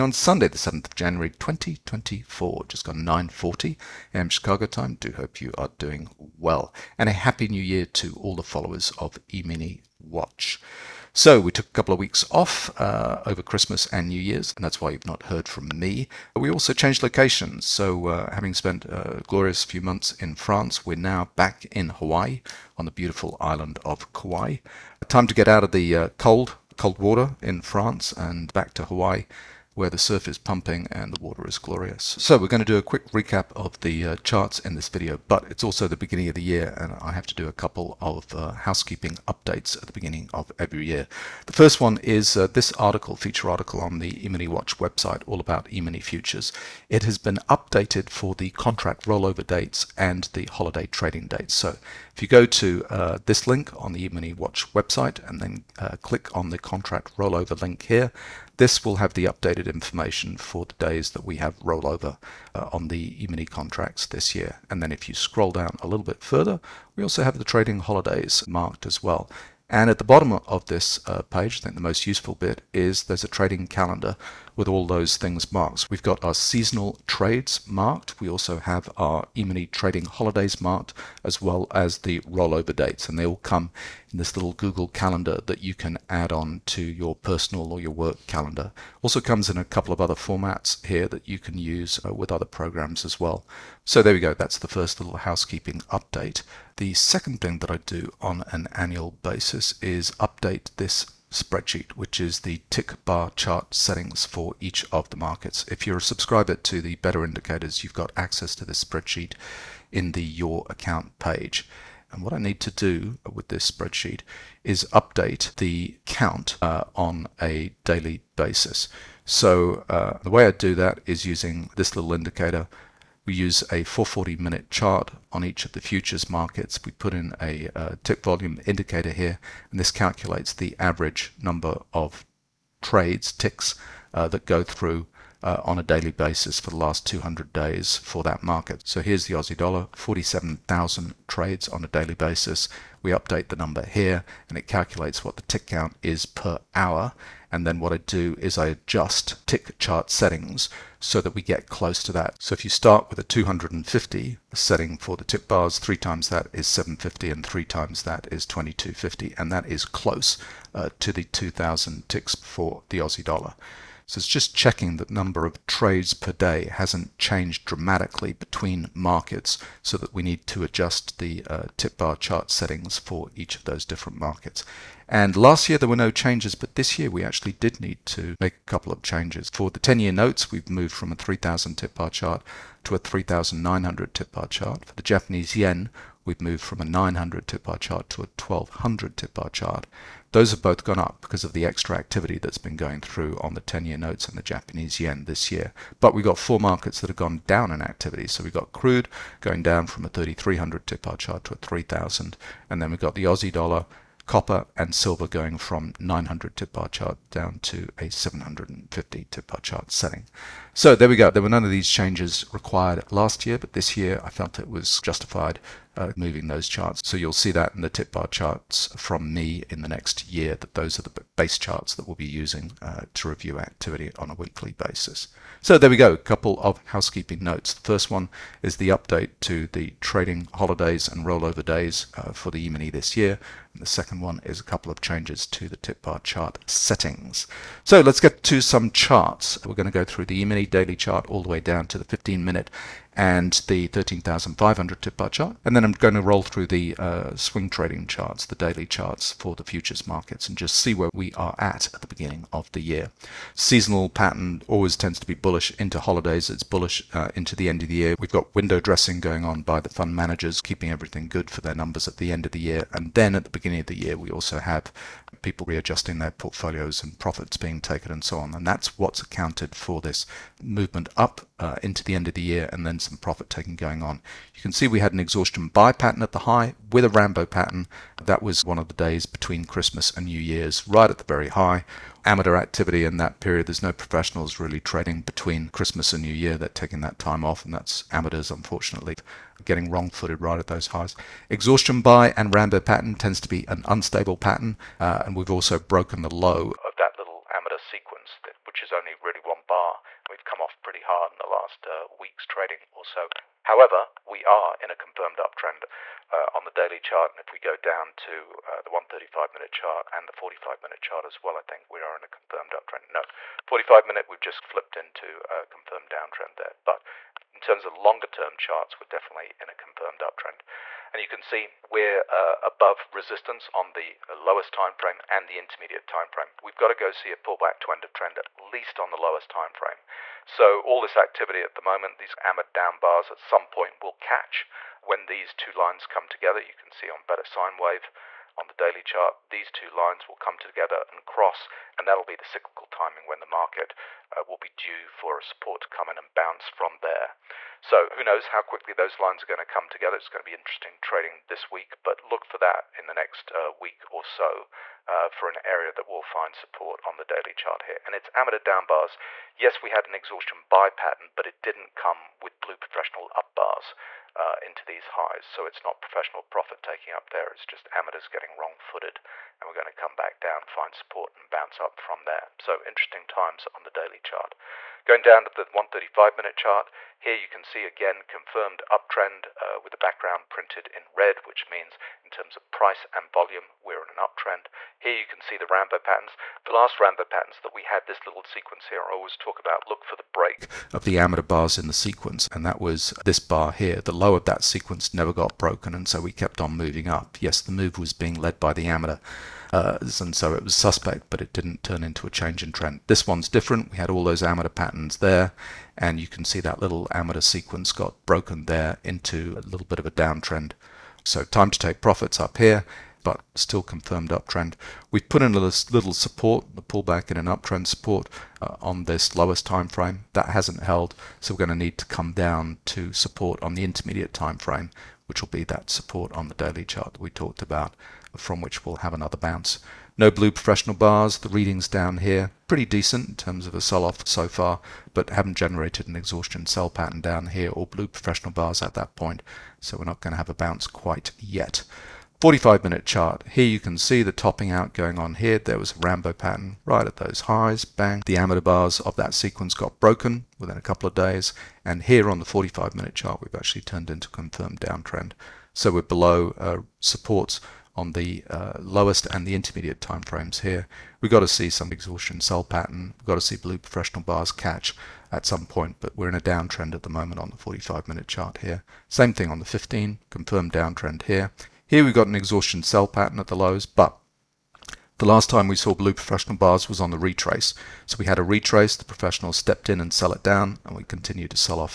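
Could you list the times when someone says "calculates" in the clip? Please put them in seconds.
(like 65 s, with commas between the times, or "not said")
129 s, 144 s.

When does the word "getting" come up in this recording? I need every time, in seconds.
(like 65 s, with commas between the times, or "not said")
289 s, 368 s.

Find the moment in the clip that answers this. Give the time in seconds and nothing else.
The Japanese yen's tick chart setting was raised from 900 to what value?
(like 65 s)
188 s.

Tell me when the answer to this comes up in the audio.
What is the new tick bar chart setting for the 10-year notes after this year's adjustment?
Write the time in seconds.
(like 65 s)
182 s.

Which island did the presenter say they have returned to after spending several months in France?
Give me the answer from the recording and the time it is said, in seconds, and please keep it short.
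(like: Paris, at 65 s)
Kauai, at 24 s.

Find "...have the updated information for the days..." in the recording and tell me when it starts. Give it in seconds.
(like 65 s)
58 s.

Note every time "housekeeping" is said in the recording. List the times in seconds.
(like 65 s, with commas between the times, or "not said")
38 s, 95 s, 226 s.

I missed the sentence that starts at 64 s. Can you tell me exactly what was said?
And then if you scroll down a little bit further, we also have the trading holidays marked as well.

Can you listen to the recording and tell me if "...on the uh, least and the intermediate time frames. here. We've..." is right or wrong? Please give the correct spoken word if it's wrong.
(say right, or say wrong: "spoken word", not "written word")
wrong: "lowest", not "least".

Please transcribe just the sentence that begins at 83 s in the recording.
And they all come in this little Google calendar that you can add on to your personal or your work calendar.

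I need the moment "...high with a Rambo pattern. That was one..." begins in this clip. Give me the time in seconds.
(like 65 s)
276 s.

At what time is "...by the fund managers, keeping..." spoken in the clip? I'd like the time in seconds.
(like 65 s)
259 s.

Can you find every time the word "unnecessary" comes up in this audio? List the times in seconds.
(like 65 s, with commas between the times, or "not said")
not said.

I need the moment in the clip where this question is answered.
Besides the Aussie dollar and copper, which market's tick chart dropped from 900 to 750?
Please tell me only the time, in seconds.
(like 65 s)
204 s.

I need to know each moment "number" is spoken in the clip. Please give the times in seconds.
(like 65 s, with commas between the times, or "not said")
131 s, 143 s, 165 s, 261 s.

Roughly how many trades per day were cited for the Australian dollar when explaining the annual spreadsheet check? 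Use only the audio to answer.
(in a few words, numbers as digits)
47,000.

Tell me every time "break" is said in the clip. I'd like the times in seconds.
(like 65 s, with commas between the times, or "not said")
390 s.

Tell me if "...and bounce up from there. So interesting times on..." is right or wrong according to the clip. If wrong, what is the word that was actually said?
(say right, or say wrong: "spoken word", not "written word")
right.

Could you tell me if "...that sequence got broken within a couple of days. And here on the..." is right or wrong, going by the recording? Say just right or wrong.
right.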